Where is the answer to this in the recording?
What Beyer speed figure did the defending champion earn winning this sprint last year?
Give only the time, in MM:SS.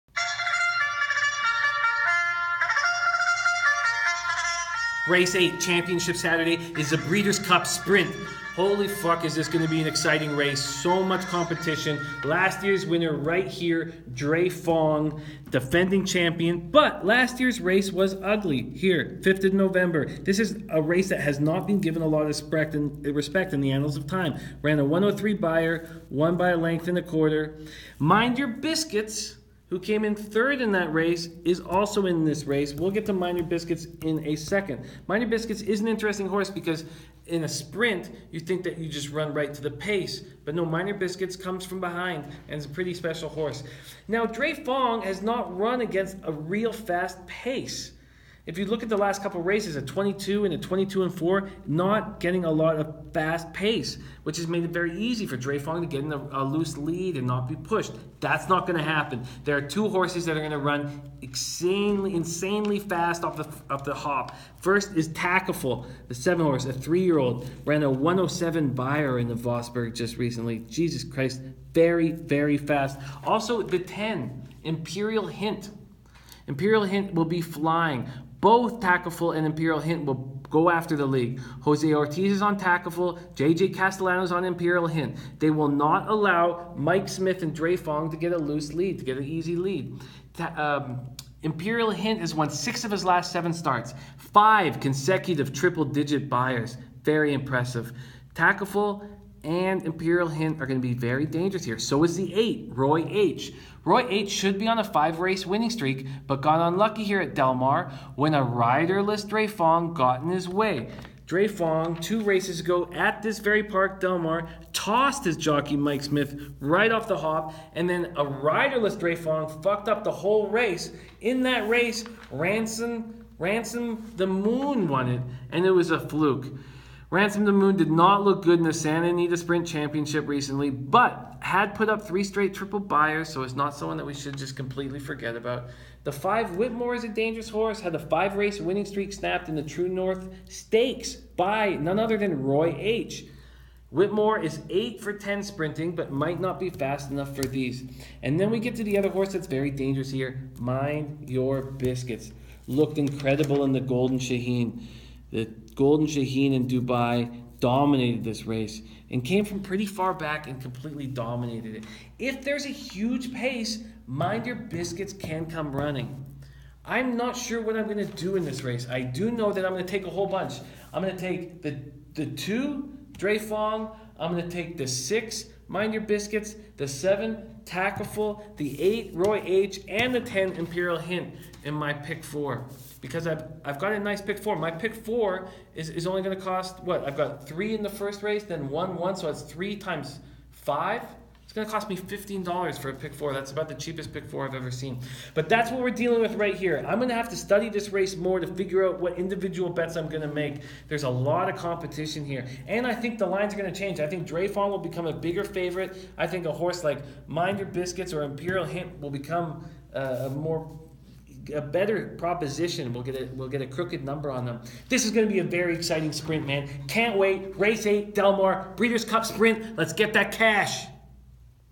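00:24.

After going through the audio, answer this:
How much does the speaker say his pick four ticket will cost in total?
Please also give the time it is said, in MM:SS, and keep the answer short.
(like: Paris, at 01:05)
$15, at 03:11.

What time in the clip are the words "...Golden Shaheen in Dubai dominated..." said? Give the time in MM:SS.
02:35.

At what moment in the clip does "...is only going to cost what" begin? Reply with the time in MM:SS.
03:05.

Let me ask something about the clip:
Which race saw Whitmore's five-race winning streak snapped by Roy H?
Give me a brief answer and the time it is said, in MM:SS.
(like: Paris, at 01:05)
True North Stakes, at 02:19.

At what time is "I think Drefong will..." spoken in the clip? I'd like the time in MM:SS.
03:23.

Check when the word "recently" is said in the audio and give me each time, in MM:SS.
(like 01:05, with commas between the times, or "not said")
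01:10, 02:10.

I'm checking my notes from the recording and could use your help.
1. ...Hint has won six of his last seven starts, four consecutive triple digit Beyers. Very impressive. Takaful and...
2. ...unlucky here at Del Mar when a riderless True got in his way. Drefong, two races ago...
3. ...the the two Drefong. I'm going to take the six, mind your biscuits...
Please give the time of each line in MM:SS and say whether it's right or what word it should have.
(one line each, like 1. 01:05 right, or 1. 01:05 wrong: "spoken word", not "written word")
1. 01:31 wrong: "five", not "four"
2. 01:46 wrong: "Drefong", not "True"
3. 02:51 right.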